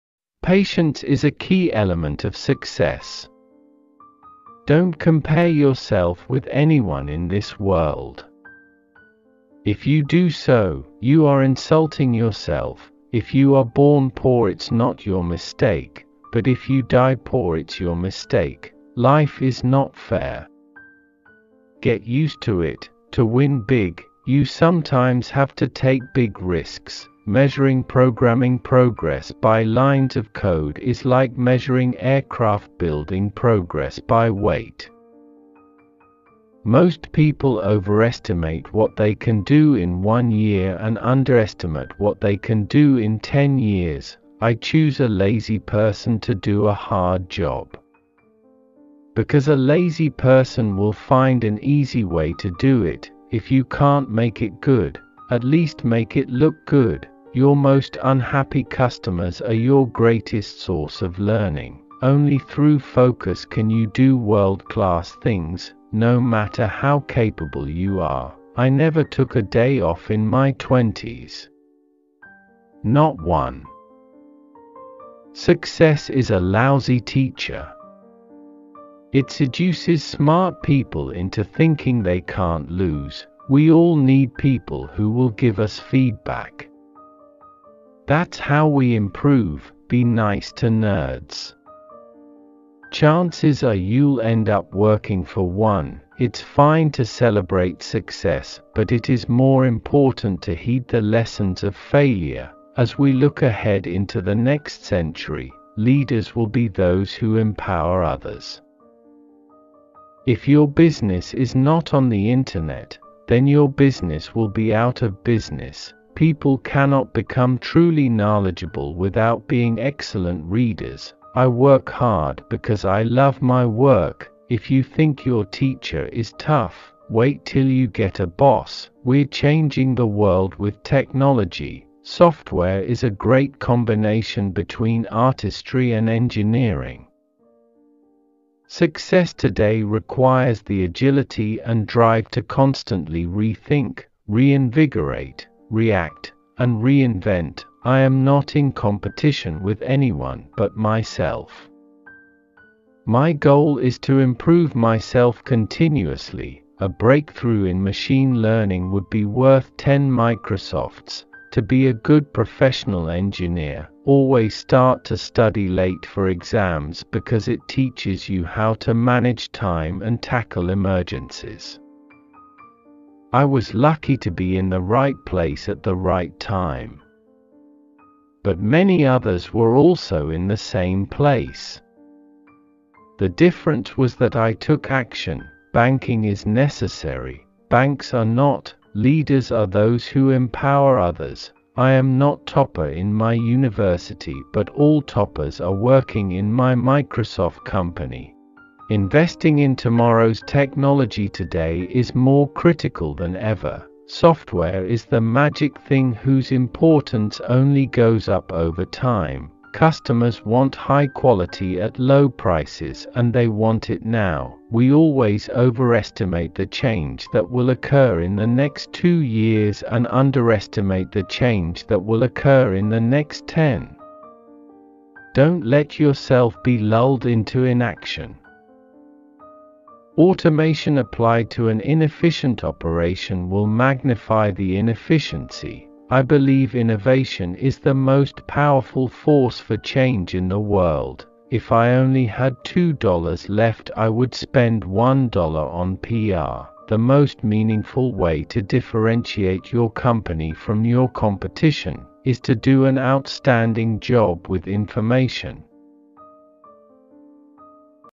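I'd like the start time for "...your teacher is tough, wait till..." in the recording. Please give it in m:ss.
2:05.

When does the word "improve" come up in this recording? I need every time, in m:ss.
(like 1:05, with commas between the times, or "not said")
1:28, 2:34.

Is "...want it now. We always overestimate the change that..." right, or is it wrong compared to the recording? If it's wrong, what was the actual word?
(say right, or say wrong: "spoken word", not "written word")
right.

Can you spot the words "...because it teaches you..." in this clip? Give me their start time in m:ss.
2:47.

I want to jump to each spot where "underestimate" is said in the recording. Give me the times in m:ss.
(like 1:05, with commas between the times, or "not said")
0:40, 3:40.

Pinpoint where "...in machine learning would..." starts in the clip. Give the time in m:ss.
2:37.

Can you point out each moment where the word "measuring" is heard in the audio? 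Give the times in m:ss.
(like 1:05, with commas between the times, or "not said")
0:27, 0:31.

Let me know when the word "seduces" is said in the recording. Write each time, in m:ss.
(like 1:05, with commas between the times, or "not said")
1:19.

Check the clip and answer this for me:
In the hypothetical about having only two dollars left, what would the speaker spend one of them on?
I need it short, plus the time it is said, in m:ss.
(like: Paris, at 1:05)
PR, at 4:05.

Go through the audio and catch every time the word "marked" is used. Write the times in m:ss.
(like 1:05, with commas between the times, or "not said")
not said.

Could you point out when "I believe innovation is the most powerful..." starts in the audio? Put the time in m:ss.
3:56.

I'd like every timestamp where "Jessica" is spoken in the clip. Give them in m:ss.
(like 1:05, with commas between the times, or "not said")
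not said.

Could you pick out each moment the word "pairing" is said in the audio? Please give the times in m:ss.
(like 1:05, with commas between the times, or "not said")
not said.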